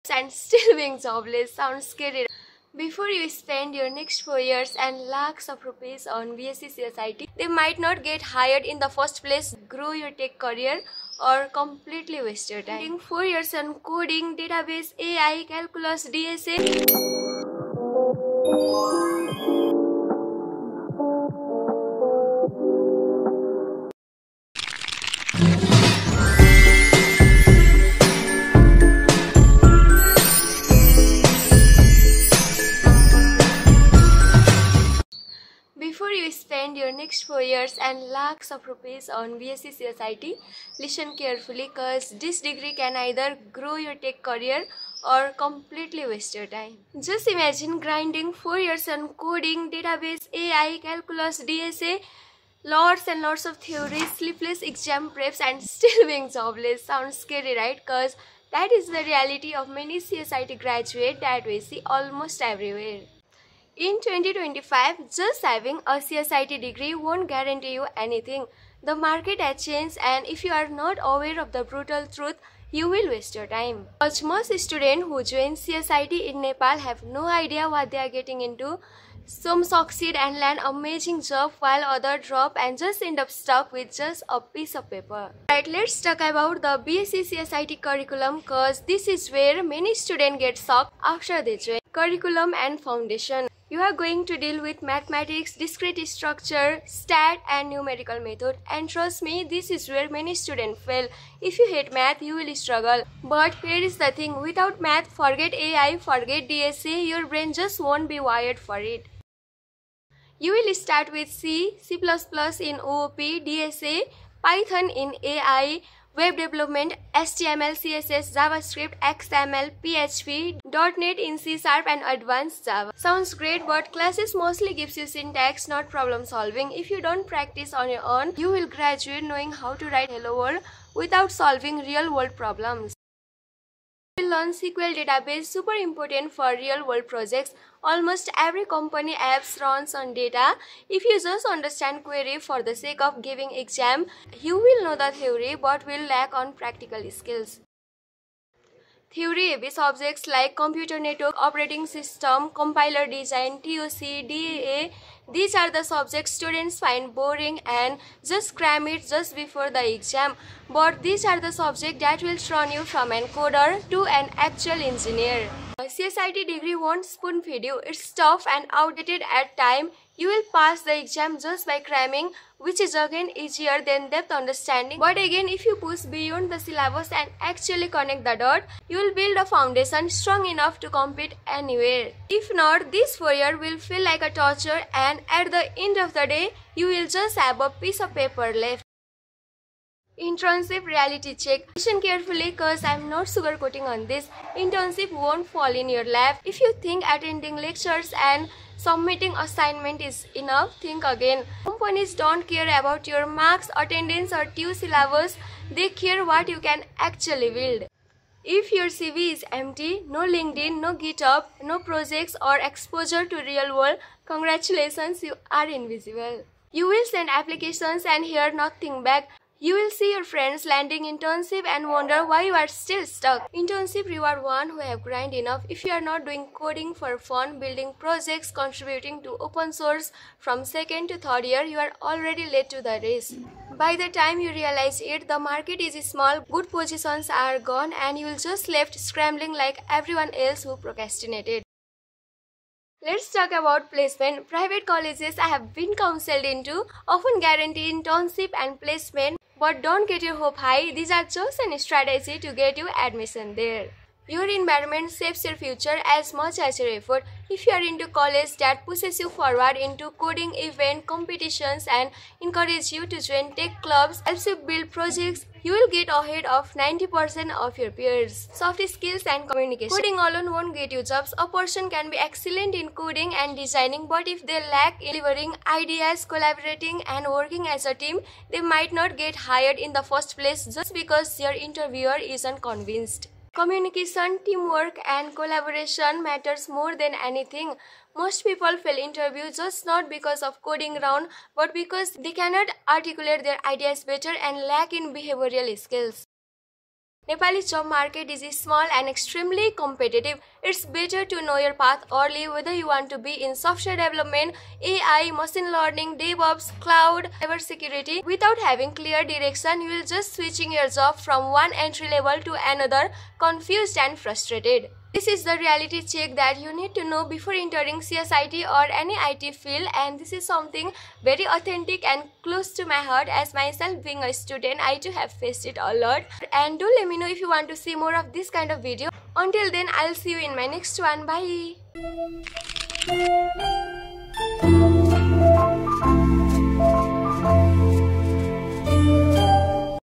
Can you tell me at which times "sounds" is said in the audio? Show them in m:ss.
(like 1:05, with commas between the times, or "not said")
0:01, 0:56, 2:02.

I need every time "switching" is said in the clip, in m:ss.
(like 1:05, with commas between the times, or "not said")
5:10.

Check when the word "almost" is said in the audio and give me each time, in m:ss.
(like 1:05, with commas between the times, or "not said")
1:01, 2:17.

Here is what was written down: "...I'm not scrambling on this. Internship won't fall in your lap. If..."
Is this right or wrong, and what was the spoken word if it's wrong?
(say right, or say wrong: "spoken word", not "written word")
wrong: "sugarcoating", not "scrambling".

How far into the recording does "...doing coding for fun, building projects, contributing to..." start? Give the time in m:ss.
3:46.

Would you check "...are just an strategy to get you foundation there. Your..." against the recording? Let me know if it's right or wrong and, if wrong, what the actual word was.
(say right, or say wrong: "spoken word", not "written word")
wrong: "admission", not "foundation".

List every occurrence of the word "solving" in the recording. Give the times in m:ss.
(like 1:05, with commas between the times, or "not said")
2:06, 2:11.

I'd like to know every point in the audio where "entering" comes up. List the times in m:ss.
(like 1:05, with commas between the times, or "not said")
5:17.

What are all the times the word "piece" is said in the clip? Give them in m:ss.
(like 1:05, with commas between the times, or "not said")
1:24, 3:07.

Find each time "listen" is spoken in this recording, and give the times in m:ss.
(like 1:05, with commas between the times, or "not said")
0:40, 3:11.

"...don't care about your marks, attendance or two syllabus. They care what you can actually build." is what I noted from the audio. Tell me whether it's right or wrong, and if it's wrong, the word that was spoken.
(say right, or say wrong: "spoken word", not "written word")
right.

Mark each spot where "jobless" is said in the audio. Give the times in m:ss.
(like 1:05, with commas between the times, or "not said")
0:00, 0:56.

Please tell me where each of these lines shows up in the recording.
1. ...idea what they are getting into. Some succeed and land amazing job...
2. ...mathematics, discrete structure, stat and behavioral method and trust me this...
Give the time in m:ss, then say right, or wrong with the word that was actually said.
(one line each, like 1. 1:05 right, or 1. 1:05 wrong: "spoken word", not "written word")
1. 1:17 right
2. 1:34 wrong: "numerical", not "behavioral".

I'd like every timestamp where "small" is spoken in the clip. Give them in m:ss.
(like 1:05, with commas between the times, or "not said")
3:56, 4:58.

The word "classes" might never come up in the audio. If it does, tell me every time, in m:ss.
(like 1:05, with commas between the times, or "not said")
2:03.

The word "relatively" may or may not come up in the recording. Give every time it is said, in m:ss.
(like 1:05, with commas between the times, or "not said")
not said.